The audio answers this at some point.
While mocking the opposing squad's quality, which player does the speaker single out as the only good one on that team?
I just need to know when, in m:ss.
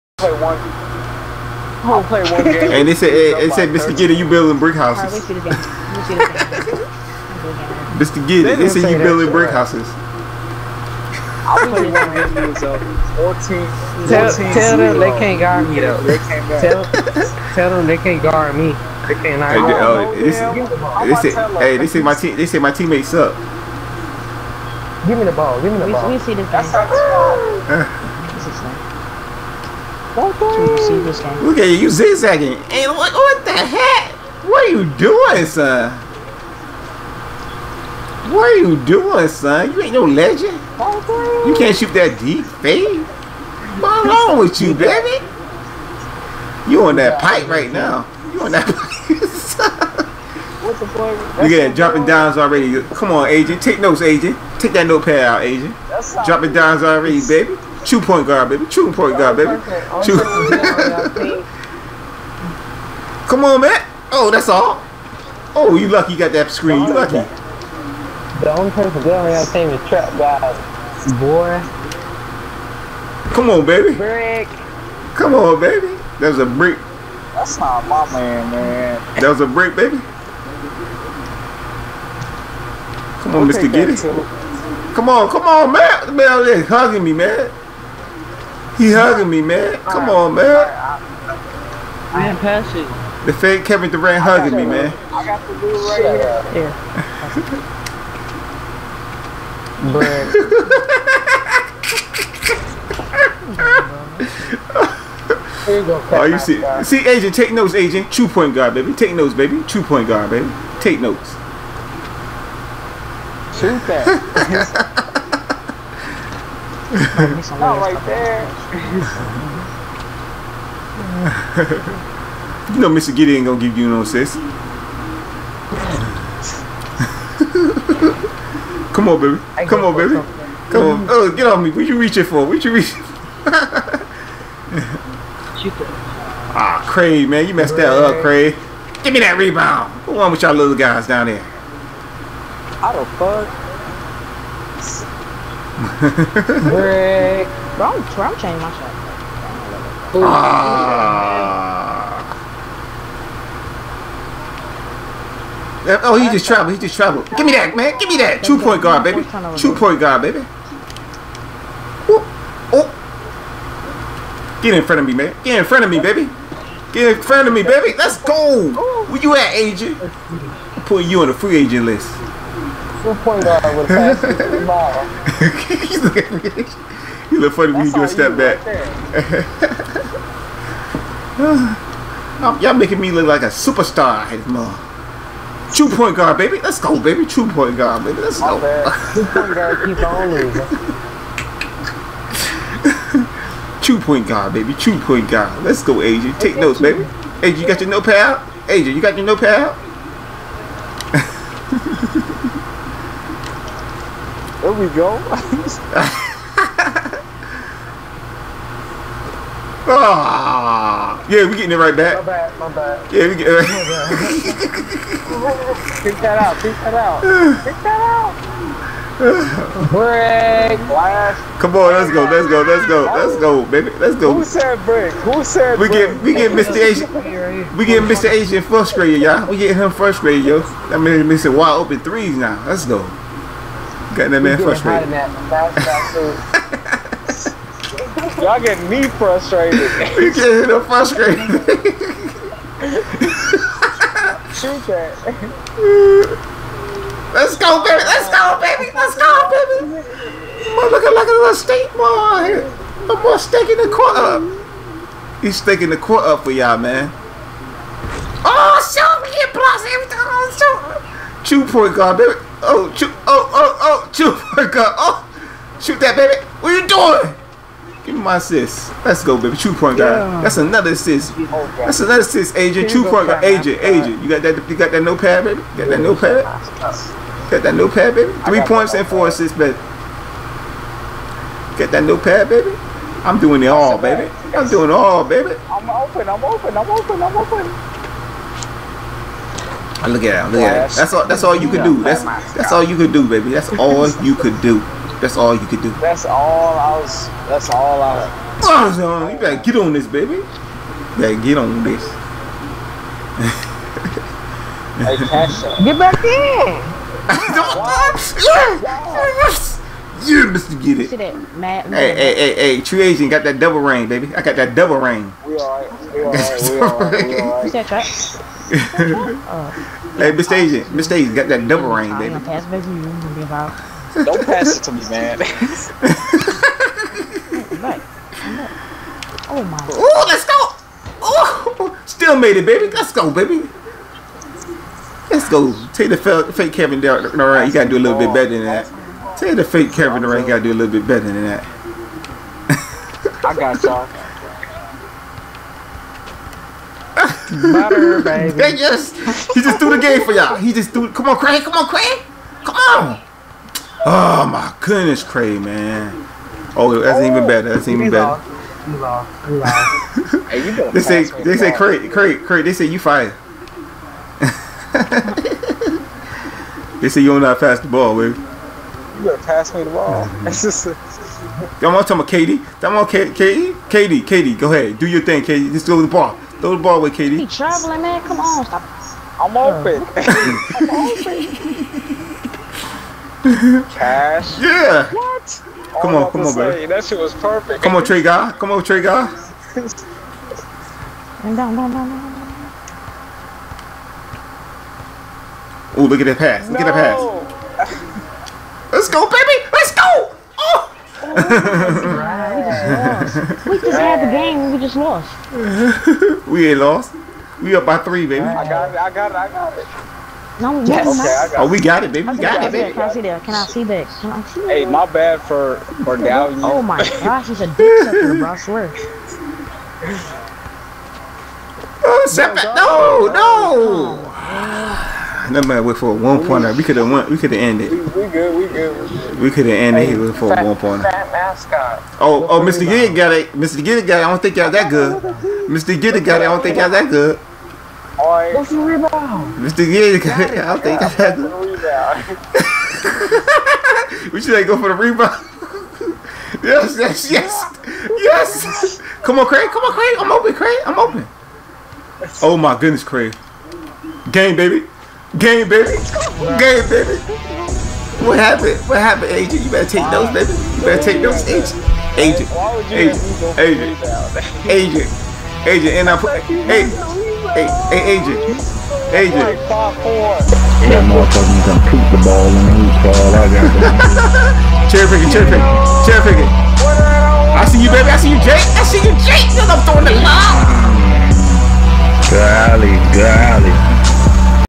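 1:09.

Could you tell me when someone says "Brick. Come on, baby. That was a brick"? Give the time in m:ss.
1:13.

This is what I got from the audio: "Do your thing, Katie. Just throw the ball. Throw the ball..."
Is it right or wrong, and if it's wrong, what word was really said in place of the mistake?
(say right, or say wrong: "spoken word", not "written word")
right.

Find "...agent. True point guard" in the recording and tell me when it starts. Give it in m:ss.
4:32.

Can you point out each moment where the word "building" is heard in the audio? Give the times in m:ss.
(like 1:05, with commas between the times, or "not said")
0:04, 0:08.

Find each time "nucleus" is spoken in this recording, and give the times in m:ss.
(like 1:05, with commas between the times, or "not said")
not said.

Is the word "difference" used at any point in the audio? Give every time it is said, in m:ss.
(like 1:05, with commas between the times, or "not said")
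not said.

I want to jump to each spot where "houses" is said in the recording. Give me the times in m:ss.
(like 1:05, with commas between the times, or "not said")
0:04, 0:09.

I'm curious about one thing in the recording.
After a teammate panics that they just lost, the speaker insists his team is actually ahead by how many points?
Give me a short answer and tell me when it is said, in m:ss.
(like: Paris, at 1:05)
3, at 6:47.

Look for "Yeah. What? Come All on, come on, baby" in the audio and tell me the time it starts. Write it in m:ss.
6:24.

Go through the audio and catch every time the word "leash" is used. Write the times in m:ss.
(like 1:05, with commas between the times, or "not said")
not said.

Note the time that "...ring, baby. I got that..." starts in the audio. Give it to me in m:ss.
5:13.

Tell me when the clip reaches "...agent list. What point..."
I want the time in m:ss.
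2:51.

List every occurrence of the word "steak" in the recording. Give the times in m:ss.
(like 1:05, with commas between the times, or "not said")
4:11.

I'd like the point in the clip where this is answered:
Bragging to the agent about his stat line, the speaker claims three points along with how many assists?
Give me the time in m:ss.
4:39.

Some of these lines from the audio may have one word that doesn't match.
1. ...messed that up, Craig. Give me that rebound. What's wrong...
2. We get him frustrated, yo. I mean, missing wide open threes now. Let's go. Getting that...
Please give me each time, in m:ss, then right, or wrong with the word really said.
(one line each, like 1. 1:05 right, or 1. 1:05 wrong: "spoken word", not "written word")
1. 2:17 right
2. 3:49 right.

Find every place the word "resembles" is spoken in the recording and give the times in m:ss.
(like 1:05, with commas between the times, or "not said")
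not said.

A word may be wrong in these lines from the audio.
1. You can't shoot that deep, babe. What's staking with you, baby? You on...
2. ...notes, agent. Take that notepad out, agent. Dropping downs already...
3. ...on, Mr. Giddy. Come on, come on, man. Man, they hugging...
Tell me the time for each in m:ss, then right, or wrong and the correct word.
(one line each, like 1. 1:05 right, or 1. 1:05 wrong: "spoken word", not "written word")
1. 0:40 wrong: "wrong", not "staking"
2. 0:53 right
3. 1:23 right.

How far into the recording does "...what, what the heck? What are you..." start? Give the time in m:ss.
0:32.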